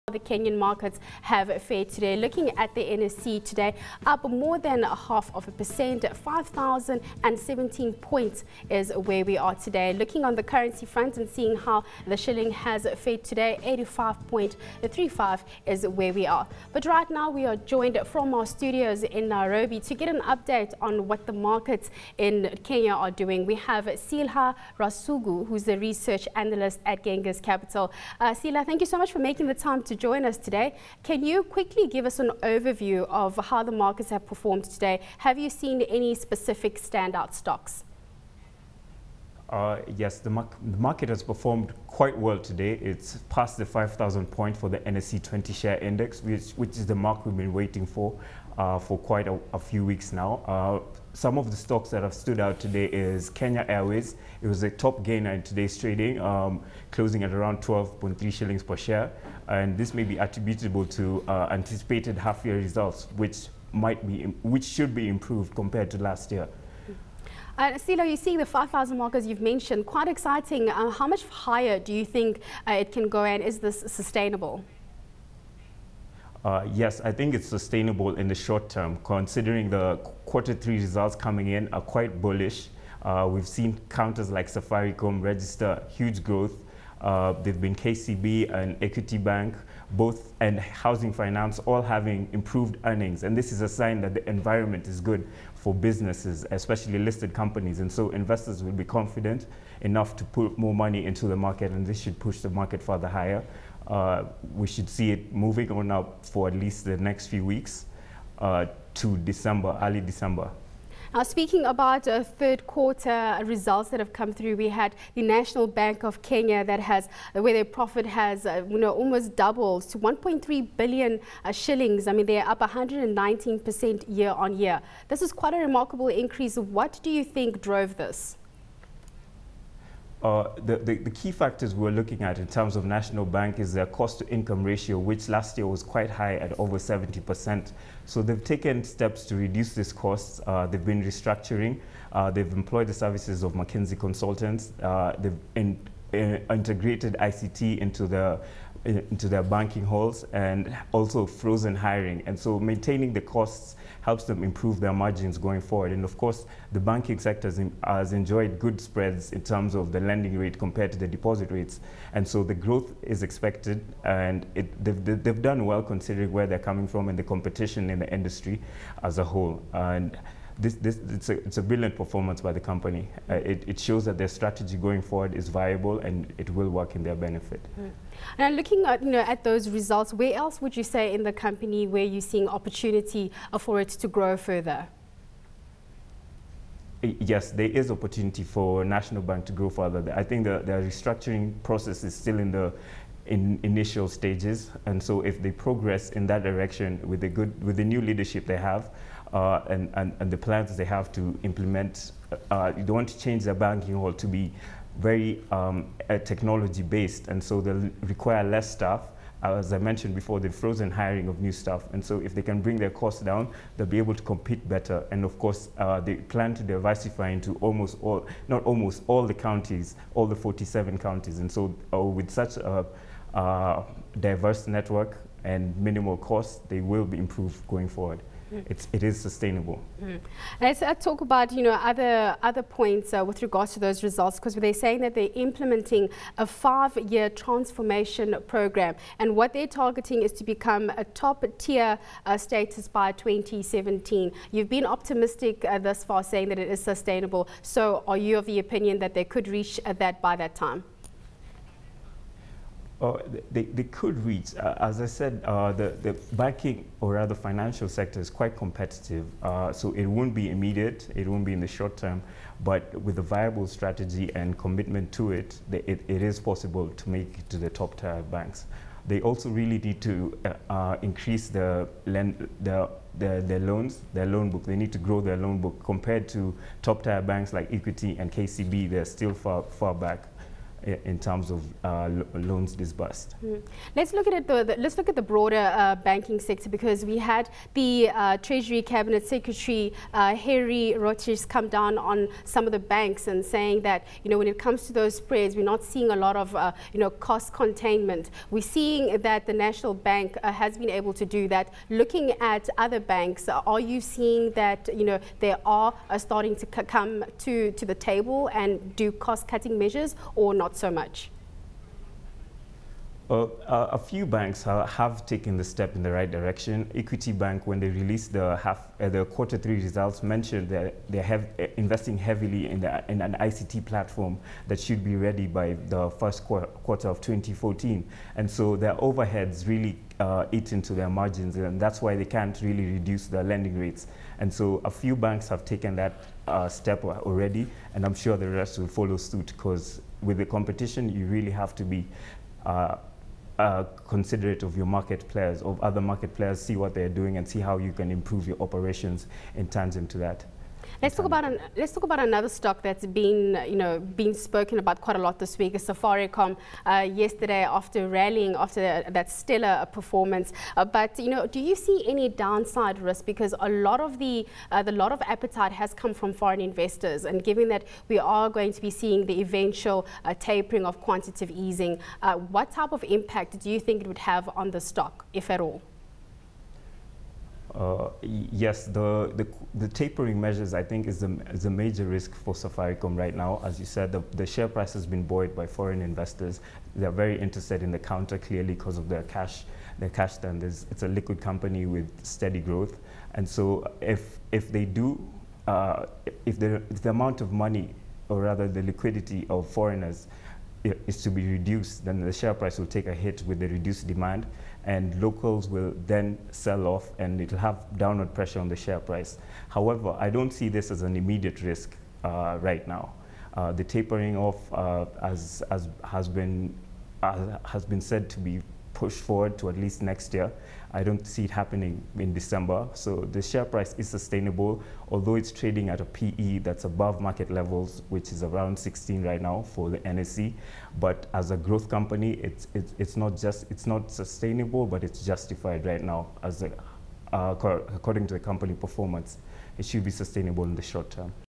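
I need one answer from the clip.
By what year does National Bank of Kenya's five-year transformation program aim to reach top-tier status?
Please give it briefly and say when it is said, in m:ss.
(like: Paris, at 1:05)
2017, at 4:03.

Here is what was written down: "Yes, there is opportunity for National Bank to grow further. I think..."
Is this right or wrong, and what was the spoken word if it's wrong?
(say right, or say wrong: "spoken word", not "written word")
right.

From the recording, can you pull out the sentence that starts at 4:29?
They also really need to uh, uh, increase the, lend, the their, their, loans, their loan book.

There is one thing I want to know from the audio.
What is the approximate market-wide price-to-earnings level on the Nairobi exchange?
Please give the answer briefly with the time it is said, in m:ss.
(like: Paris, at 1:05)
16, at 7:08.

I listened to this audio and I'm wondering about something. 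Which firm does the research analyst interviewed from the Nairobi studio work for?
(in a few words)
Genghis Capital.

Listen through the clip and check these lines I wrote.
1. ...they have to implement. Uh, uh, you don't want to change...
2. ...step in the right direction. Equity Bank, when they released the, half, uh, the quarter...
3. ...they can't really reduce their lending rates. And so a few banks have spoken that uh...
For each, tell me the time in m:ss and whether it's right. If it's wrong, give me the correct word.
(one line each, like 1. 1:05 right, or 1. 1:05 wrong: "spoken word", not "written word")
1. 3:20 right
2. 5:15 right
3. 5:32 wrong: "taken", not "spoken".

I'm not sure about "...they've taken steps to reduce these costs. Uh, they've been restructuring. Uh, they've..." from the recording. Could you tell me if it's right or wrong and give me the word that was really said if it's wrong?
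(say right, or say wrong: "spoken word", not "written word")
right.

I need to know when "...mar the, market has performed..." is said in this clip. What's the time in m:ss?
0:40.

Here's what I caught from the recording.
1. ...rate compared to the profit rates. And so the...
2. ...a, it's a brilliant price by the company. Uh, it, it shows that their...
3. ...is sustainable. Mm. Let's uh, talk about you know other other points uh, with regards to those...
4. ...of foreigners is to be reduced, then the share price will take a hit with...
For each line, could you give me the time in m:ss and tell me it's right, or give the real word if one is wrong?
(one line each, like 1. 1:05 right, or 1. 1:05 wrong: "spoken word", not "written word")
1. 2:40 wrong: "deposit", not "profit"
2. 2:51 wrong: "performance", not "price"
3. 3:49 right
4. 6:39 right.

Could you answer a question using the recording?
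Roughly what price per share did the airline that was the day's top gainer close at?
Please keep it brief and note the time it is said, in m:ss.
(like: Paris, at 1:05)
12.3 shillings, at 0:57.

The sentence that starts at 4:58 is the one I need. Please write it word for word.
We're seeing that the National Bank uh, has been able to do that.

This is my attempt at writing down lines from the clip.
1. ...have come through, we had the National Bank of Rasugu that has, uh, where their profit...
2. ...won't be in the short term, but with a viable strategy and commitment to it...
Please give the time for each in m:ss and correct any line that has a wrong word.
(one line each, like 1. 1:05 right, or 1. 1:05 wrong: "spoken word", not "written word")
1. 1:53 wrong: "Kenya", not "Rasugu"
2. 4:21 right.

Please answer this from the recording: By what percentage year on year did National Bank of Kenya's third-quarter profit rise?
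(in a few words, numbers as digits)
119%.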